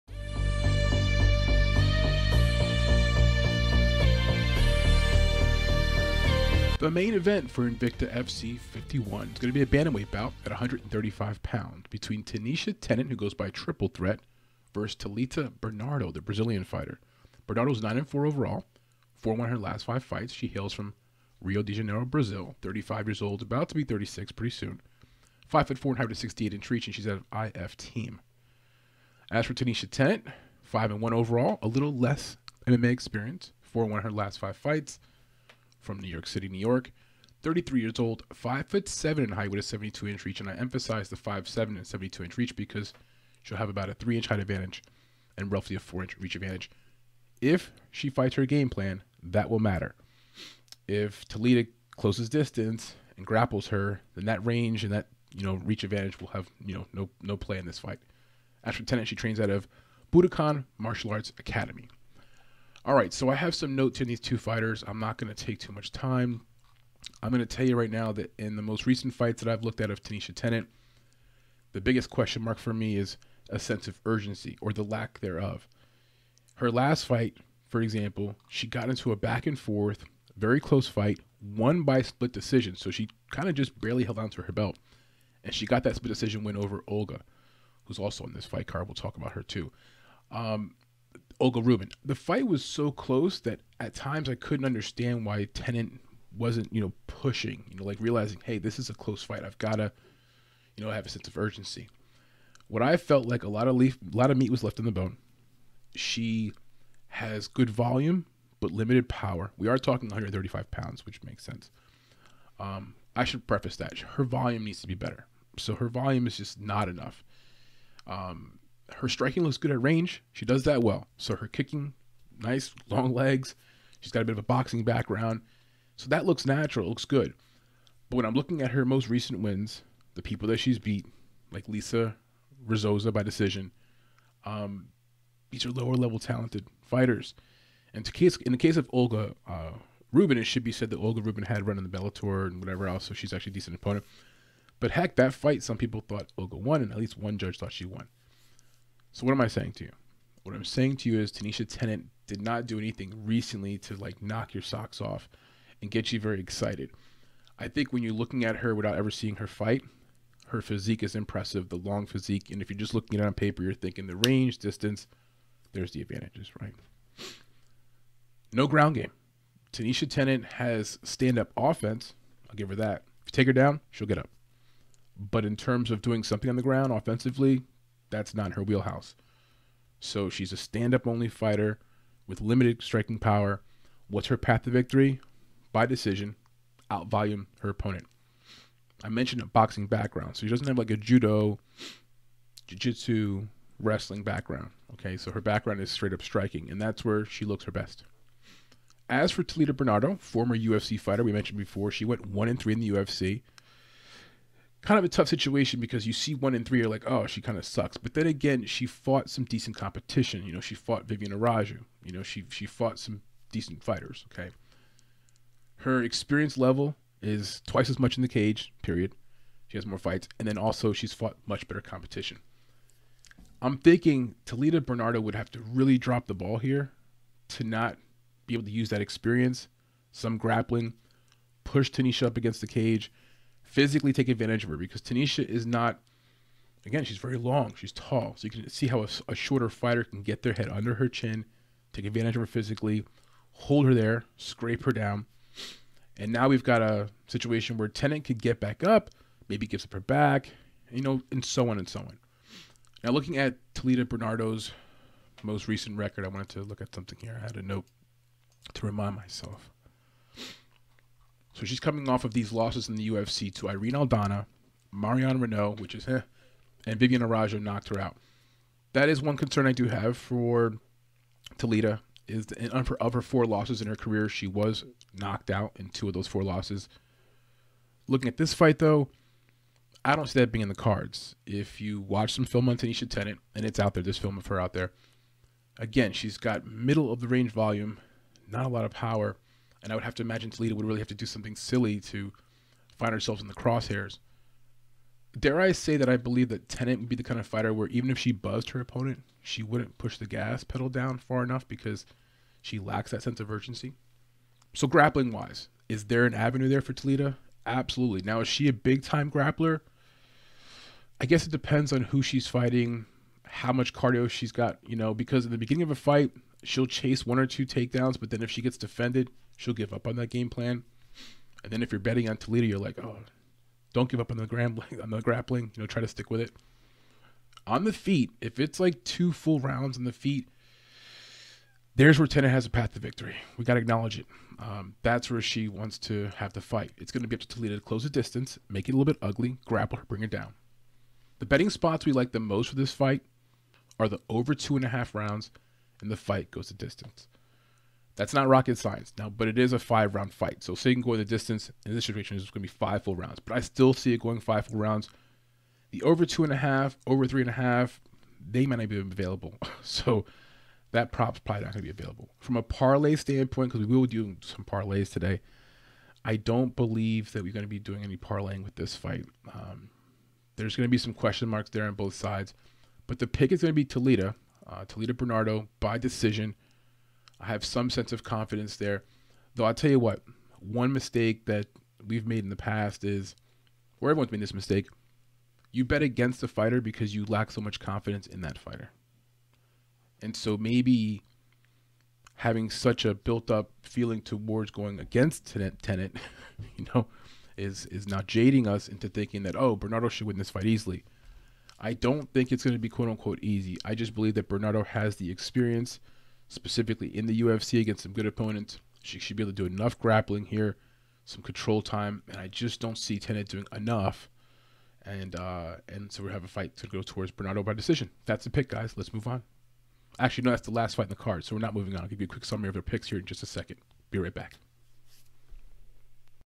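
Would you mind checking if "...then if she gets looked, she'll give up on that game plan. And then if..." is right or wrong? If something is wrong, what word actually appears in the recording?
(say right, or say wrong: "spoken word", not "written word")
wrong: "defended", not "looked".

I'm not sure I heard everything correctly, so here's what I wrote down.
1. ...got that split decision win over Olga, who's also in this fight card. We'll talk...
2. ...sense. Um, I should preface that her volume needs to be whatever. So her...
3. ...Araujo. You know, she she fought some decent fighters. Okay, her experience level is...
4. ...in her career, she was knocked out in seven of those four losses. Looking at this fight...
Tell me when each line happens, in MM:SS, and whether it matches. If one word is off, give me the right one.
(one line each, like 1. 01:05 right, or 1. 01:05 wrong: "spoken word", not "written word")
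1. 01:25 right
2. 01:51 wrong: "better", not "whatever"
3. 03:31 right
4. 04:33 wrong: "two", not "seven".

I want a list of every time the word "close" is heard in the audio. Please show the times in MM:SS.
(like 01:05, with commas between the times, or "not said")
00:51, 01:20, 01:32, 01:38, 05:37.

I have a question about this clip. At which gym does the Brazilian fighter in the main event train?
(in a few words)
IF team.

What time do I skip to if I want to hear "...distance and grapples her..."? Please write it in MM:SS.
00:52.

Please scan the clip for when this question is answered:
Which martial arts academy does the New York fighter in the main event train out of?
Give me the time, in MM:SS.
01:00.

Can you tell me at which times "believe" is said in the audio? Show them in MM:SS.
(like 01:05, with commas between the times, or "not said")
04:56, 06:06, 06:44.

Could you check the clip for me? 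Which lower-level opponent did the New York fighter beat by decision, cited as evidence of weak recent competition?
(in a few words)
Lisa Rizzoza.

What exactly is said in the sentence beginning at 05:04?
So grappling wise, is there an avenue there for Toledo?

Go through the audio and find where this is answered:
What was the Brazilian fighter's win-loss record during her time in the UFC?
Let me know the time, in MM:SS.
03:22.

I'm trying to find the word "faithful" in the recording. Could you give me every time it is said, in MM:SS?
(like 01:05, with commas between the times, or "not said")
not said.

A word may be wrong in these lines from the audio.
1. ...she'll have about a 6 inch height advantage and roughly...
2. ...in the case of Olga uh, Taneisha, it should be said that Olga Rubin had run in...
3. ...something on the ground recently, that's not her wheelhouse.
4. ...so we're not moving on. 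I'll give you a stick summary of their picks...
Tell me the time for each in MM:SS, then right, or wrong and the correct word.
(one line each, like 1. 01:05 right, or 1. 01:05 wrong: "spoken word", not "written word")
1. 00:43 wrong: "3", not "6"
2. 02:18 wrong: "Rubin", not "Taneisha"
3. 02:56 wrong: "offensively", not "recently"
4. 07:01 wrong: "quick", not "stick".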